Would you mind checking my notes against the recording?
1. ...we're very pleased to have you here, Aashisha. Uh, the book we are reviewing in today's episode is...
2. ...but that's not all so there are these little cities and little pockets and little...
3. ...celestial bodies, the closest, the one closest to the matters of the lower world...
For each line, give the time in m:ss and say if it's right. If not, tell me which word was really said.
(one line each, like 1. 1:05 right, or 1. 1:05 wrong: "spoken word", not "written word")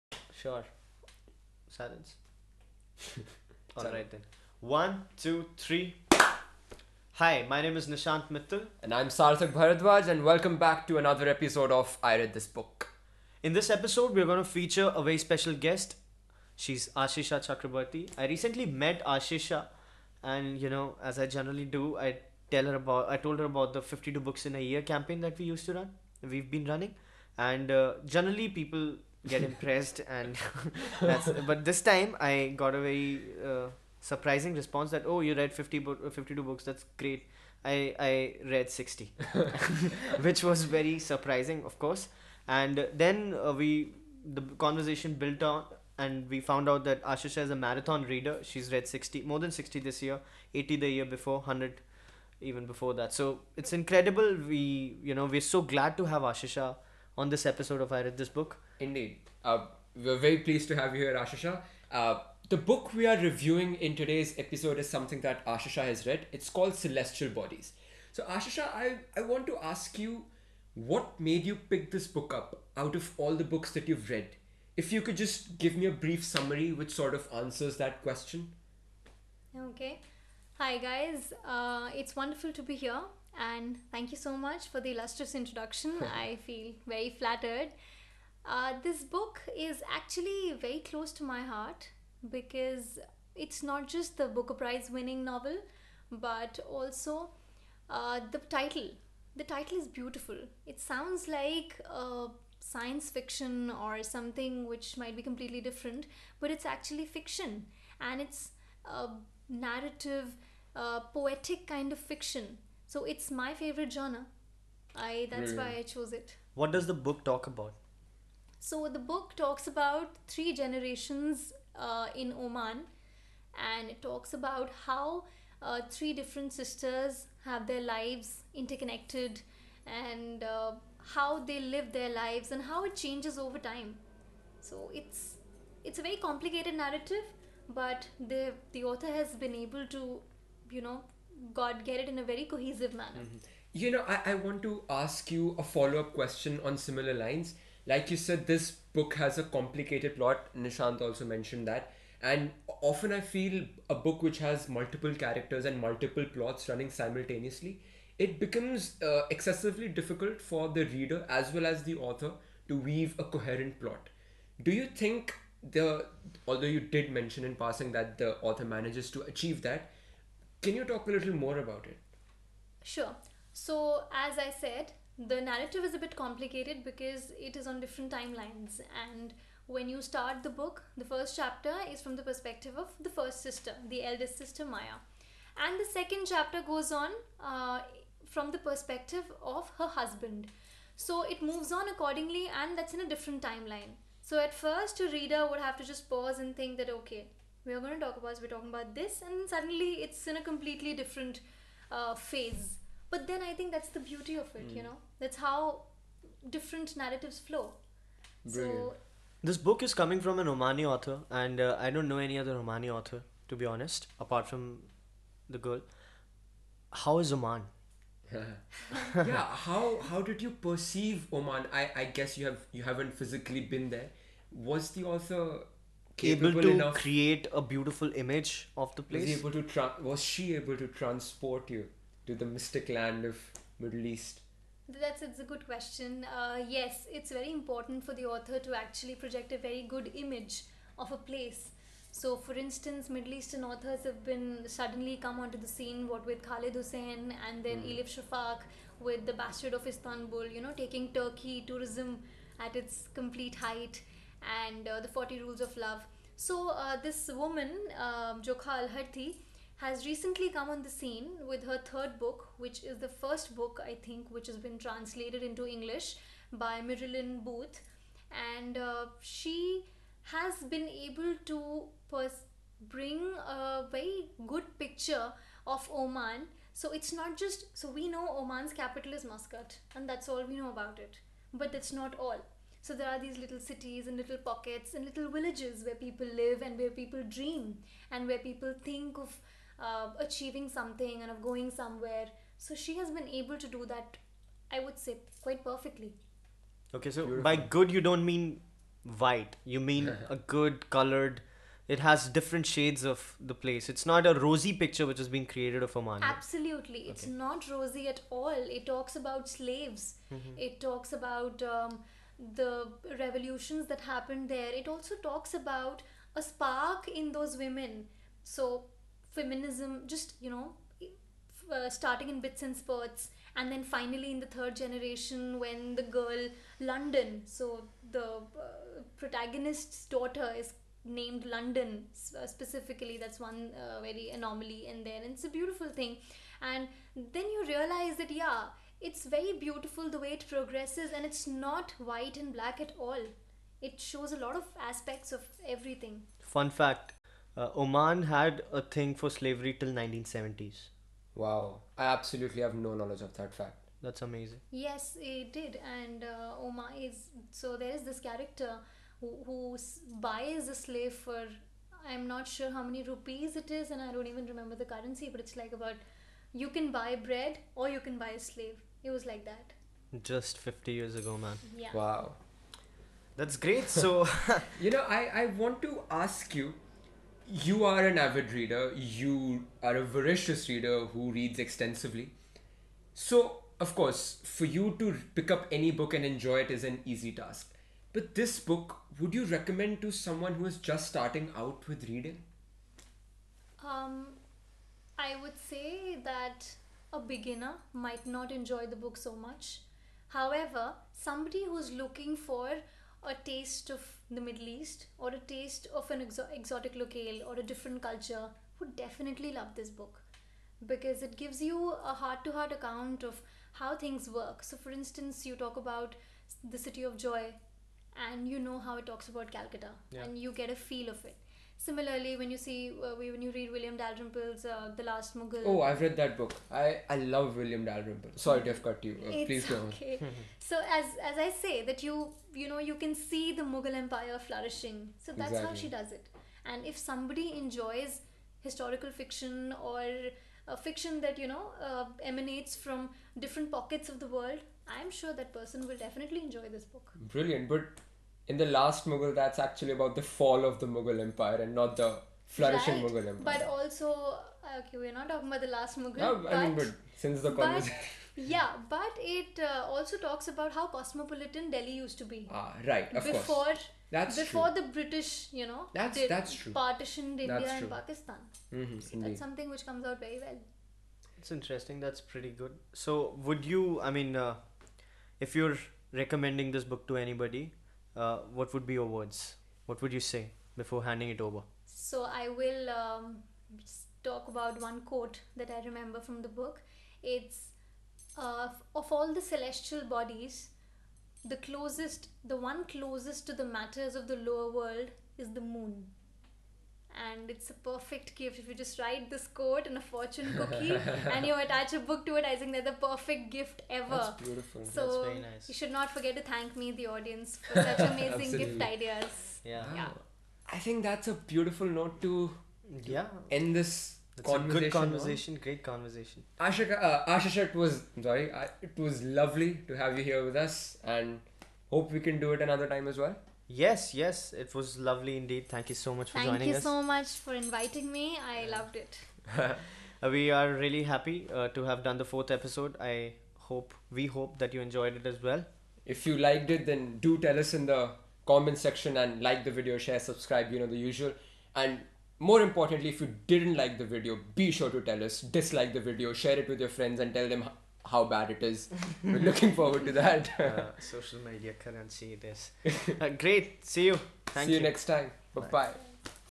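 1. 0:59 right
2. 4:41 right
3. 8:09 right.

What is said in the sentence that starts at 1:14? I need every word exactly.
If you could just give me a brief summary which sort of answers that question.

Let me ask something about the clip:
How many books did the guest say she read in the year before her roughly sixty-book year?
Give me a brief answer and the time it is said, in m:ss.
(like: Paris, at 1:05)
80, at 0:50.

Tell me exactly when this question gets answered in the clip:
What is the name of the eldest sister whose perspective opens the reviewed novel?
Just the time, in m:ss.
3:04.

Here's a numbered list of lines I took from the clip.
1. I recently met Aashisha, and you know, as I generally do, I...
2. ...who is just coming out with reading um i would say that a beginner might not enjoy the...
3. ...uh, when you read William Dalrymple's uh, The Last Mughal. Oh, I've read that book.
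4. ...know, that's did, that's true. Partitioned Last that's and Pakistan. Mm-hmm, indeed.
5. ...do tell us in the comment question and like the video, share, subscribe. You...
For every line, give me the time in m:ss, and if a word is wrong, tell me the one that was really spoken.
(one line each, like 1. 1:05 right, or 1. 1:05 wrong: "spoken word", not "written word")
1. 0:18 right
2. 6:30 wrong: "starting", not "coming"
3. 7:03 right
4. 7:45 wrong: "India", not "Last"
5. 8:57 wrong: "section", not "question".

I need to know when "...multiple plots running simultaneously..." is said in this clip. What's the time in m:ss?
2:35.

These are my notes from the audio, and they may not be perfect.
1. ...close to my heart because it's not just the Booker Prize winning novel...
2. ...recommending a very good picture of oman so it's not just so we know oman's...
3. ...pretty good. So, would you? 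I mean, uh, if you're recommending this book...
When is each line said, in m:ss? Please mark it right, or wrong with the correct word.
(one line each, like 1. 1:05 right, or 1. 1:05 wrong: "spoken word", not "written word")
1. 1:30 right
2. 4:32 wrong: "bring", not "recommending"
3. 7:52 right.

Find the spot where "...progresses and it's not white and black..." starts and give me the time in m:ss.
5:40.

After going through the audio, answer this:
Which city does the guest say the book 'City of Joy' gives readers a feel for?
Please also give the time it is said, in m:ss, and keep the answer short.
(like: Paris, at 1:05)
Calcutta, at 6:59.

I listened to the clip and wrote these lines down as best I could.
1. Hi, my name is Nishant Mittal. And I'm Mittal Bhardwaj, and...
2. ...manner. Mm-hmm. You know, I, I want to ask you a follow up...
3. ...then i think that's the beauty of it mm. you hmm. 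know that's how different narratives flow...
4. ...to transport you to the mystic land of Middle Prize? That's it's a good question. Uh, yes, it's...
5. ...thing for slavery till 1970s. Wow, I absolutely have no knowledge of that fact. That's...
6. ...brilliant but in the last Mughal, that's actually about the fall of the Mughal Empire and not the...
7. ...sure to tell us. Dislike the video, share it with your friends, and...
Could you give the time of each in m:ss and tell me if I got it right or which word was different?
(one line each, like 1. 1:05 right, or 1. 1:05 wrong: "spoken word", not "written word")
1. 0:07 wrong: "Sarthak", not "Mittal"
2. 2:22 right
3. 3:23 right
4. 3:50 wrong: "East", not "Prize"
5. 5:48 right
6. 7:27 right
7. 9:04 right.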